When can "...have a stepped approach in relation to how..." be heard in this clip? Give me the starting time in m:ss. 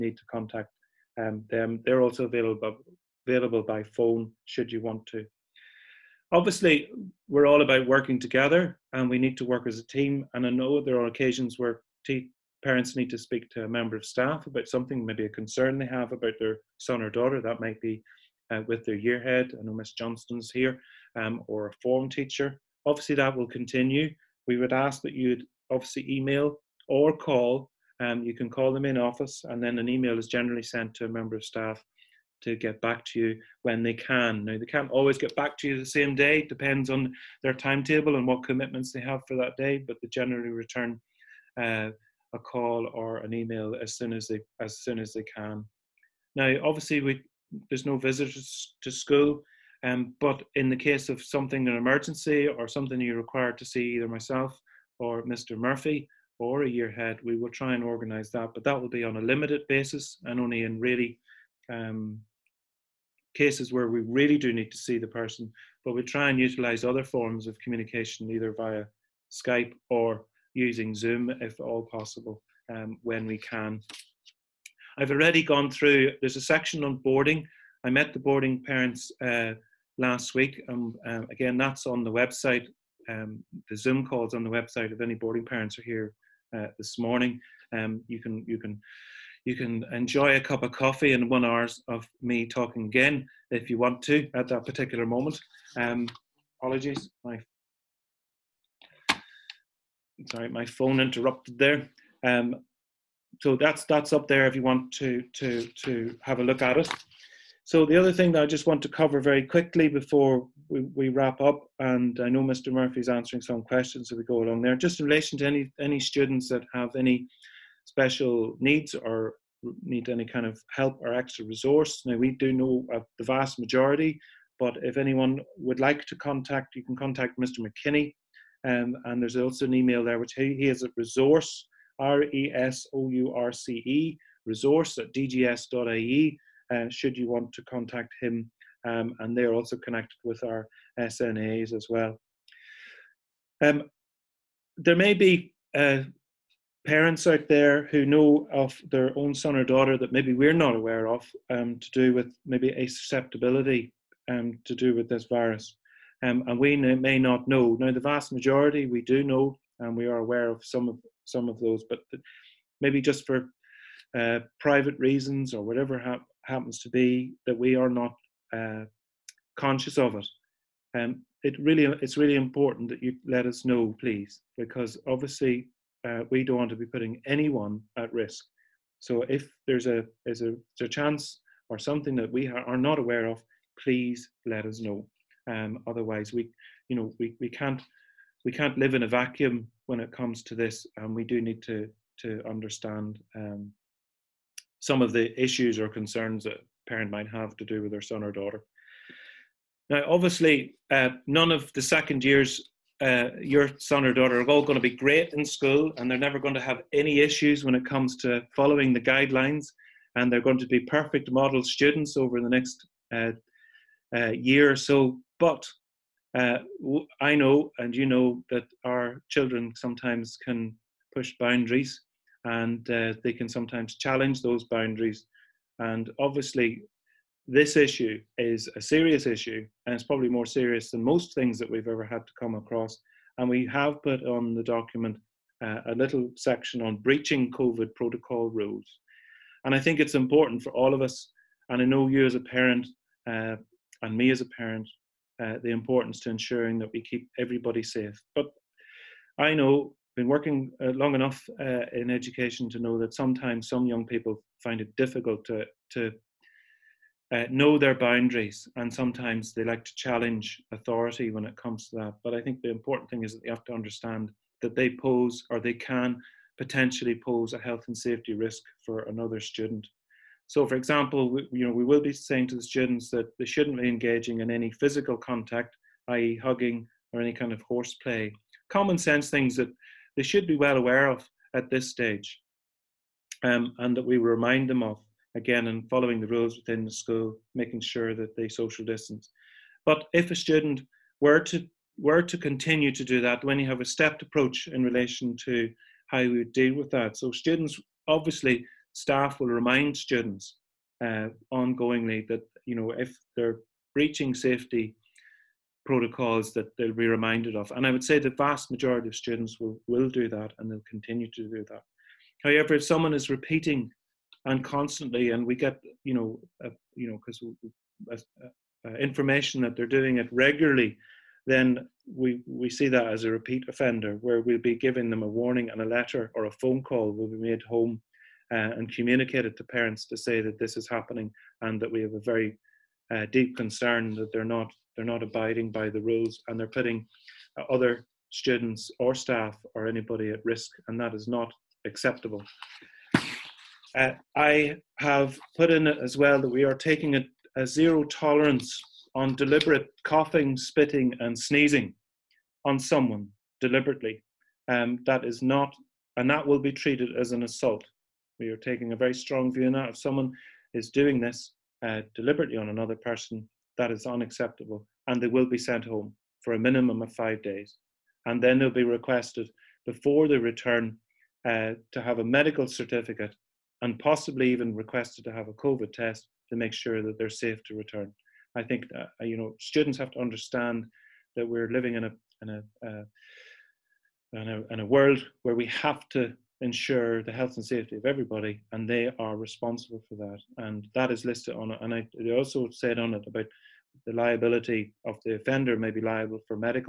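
4:53.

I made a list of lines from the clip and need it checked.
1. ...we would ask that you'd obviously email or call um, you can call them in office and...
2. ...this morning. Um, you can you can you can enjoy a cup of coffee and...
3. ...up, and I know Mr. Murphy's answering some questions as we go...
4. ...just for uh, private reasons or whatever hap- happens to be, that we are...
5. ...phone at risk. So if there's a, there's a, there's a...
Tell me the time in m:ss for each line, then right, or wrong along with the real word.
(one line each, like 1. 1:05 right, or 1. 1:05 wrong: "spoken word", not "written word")
1. 0:24 right
2. 1:26 right
3. 1:51 right
4. 2:43 right
5. 2:57 wrong: "anyone", not "phone".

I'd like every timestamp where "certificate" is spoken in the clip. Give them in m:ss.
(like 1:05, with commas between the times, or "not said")
6:12.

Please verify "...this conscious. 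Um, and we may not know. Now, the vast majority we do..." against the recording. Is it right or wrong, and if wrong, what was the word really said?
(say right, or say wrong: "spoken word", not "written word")
wrong: "virus", not "conscious".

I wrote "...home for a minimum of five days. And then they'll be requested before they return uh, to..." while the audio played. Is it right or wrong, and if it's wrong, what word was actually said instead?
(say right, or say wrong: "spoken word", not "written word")
right.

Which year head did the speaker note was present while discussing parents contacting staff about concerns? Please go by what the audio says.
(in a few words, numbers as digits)
Miss Johnston.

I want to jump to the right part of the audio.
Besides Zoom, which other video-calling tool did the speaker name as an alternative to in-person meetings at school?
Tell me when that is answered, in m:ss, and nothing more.
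1:09.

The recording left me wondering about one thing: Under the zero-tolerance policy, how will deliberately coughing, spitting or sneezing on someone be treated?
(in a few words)
As an assault.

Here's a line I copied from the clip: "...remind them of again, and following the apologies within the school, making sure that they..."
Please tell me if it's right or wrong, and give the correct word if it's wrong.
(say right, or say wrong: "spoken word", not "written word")
wrong: "rules", not "apologies".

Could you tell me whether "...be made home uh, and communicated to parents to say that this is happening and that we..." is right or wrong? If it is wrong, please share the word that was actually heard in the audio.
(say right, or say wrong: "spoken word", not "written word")
right.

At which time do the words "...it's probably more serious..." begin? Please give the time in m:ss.
3:49.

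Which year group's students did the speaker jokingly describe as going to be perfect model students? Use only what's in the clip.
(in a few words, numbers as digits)
Second years.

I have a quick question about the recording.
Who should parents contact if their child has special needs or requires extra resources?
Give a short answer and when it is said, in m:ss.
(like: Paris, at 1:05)
Mr. McKinney, at 2:07.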